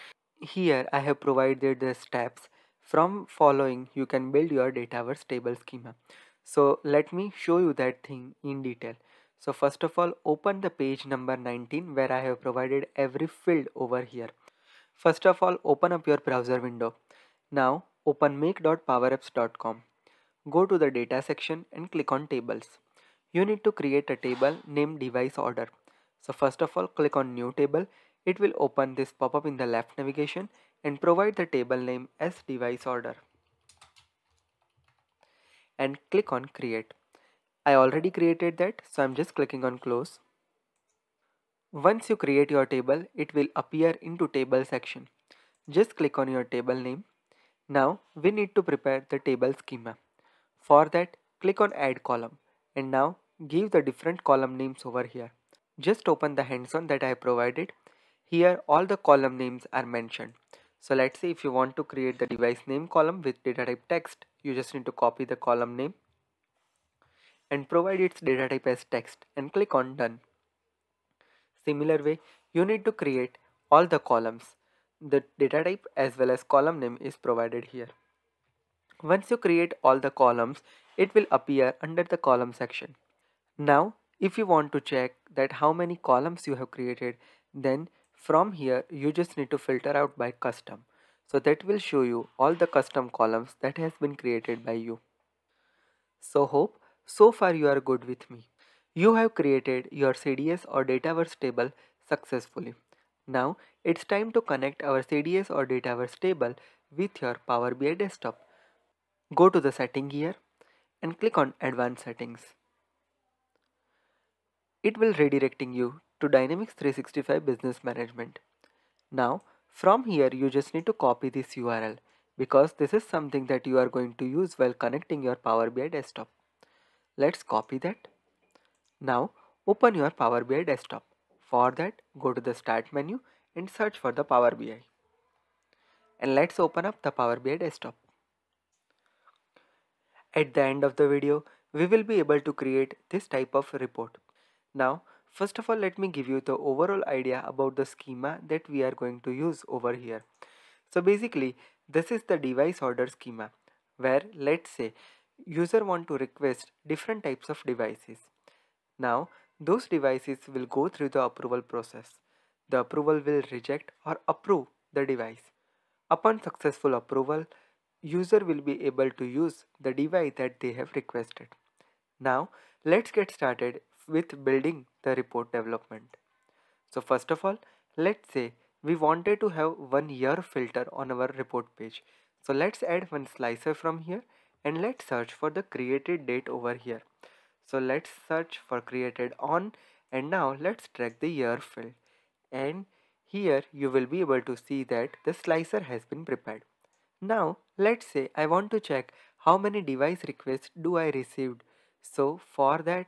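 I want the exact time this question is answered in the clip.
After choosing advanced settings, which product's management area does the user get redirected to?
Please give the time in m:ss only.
1:56.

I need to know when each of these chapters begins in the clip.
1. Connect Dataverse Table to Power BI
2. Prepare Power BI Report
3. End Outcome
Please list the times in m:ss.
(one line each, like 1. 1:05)
1. 1:49
2. 3:05
3. 2:21.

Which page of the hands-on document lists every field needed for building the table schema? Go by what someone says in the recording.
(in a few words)
19.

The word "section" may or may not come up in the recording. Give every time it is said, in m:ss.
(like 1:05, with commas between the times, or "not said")
0:21, 0:44, 1:22.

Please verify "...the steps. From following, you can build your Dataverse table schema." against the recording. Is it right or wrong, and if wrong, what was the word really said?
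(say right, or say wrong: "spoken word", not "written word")
right.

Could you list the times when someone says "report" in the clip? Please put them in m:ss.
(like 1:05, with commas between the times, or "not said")
2:23, 2:55, 3:01.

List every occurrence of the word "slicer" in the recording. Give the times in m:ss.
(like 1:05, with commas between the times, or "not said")
3:03, 3:15.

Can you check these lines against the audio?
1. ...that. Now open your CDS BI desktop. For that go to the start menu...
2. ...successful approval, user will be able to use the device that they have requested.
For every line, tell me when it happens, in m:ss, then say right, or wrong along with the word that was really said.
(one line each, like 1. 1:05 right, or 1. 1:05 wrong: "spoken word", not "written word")
1. 2:07 wrong: "Power", not "CDS"
2. 2:46 right.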